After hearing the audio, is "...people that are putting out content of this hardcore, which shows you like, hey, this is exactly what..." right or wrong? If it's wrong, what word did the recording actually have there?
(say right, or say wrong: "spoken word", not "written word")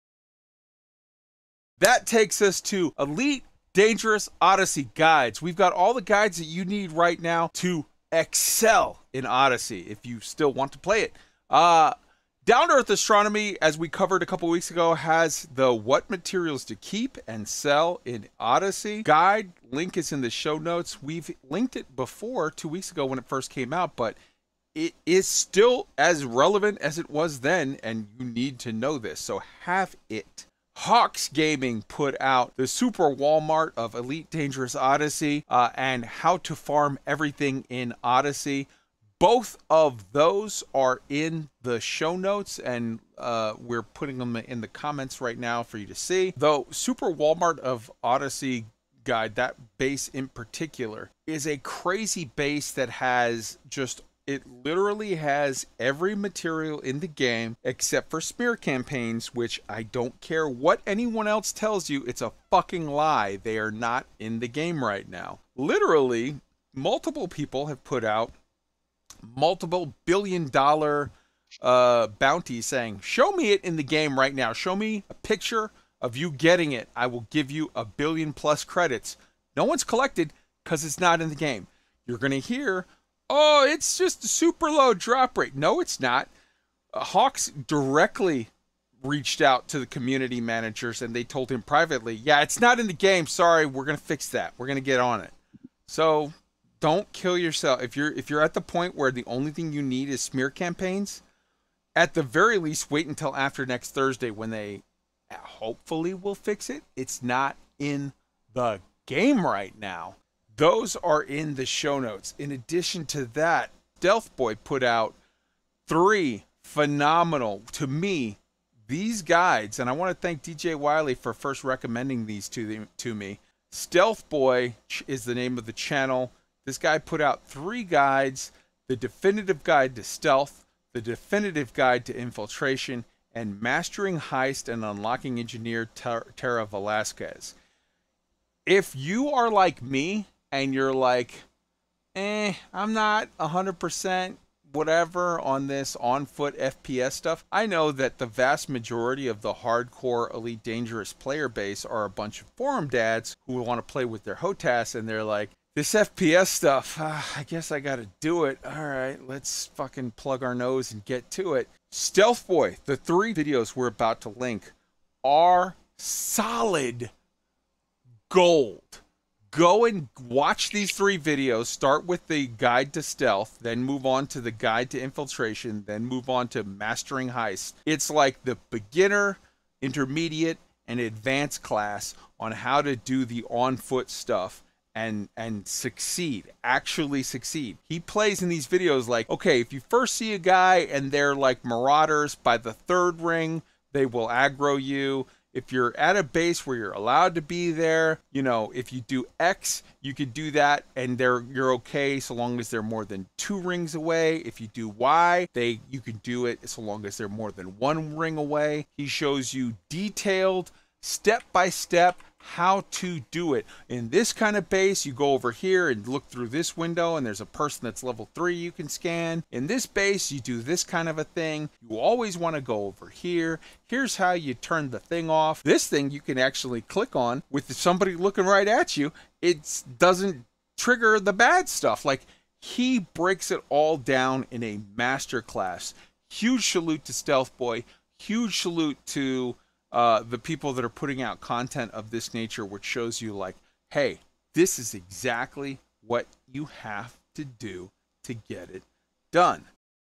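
wrong: "nature", not "hardcore".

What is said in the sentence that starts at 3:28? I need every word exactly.
He shows you detailed step by step how to do it.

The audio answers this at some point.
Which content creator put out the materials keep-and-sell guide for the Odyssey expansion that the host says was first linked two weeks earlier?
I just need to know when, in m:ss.
0:12.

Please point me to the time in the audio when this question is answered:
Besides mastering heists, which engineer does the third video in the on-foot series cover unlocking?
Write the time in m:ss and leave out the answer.
2:16.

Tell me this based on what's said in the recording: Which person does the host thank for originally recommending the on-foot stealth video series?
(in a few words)
DJ Wiley.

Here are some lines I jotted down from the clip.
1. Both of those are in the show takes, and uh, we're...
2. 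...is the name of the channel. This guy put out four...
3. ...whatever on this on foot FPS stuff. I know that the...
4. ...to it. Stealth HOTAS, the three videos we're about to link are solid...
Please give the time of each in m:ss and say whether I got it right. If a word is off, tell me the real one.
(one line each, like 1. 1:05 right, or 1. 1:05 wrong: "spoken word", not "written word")
1. 0:39 wrong: "notes", not "takes"
2. 2:05 wrong: "three", not "four"
3. 2:24 right
4. 2:41 wrong: "Boy", not "HOTAS".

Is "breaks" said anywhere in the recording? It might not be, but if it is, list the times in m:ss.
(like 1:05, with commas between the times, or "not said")
3:52.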